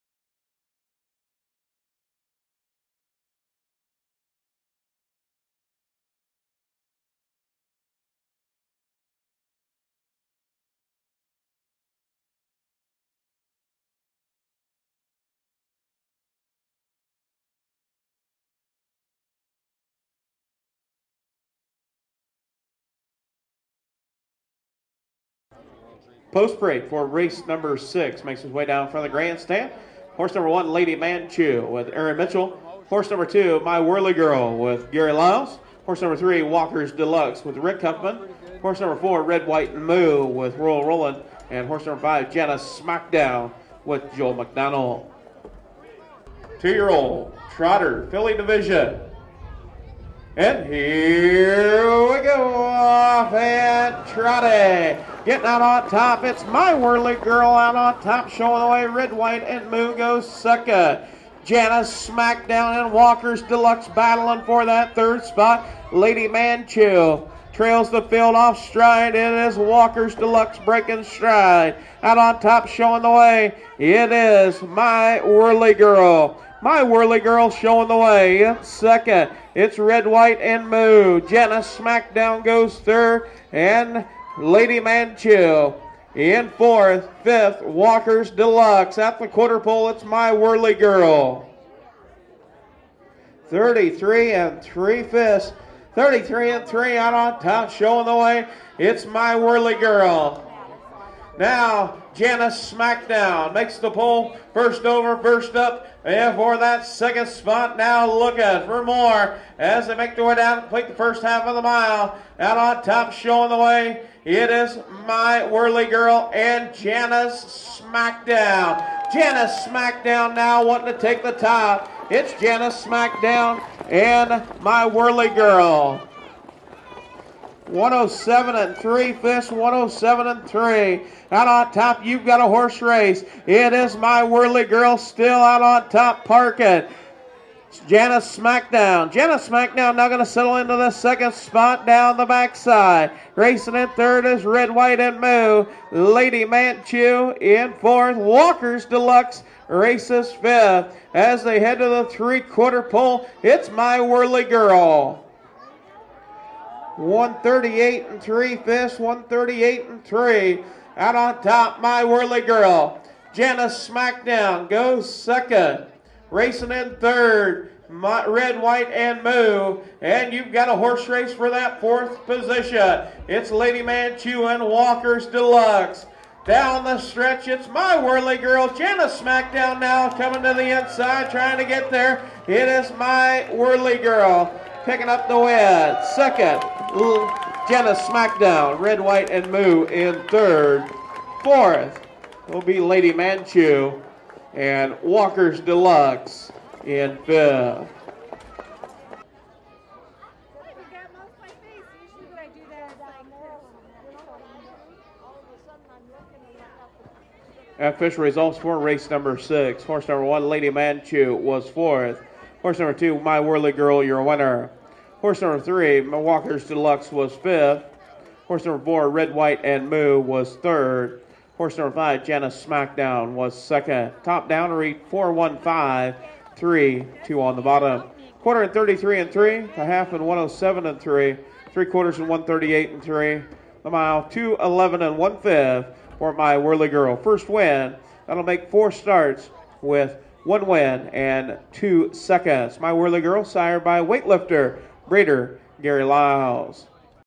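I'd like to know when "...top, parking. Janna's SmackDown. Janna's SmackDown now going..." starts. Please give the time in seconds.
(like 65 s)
135 s.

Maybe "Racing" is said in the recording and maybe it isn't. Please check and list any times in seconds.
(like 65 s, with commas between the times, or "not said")
143 s, 166 s.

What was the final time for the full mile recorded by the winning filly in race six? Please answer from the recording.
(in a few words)
2:11 1/5.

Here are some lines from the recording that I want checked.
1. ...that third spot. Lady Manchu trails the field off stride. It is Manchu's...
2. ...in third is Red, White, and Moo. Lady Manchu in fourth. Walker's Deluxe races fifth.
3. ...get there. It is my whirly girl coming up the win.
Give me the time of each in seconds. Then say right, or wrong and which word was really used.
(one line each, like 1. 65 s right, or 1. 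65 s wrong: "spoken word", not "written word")
1. 64 s wrong: "Walker", not "Manchu"
2. 143 s right
3. 181 s wrong: "picking", not "coming".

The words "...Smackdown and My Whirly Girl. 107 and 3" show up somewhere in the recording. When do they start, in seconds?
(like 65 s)
122 s.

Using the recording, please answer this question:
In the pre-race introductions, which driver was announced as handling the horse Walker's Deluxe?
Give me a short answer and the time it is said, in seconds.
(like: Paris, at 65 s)
Rick Huffman, at 37 s.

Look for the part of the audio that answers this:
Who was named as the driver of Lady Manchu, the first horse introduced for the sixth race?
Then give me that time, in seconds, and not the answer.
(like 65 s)
31 s.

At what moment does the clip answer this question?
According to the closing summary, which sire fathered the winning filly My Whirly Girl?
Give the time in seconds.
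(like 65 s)
244 s.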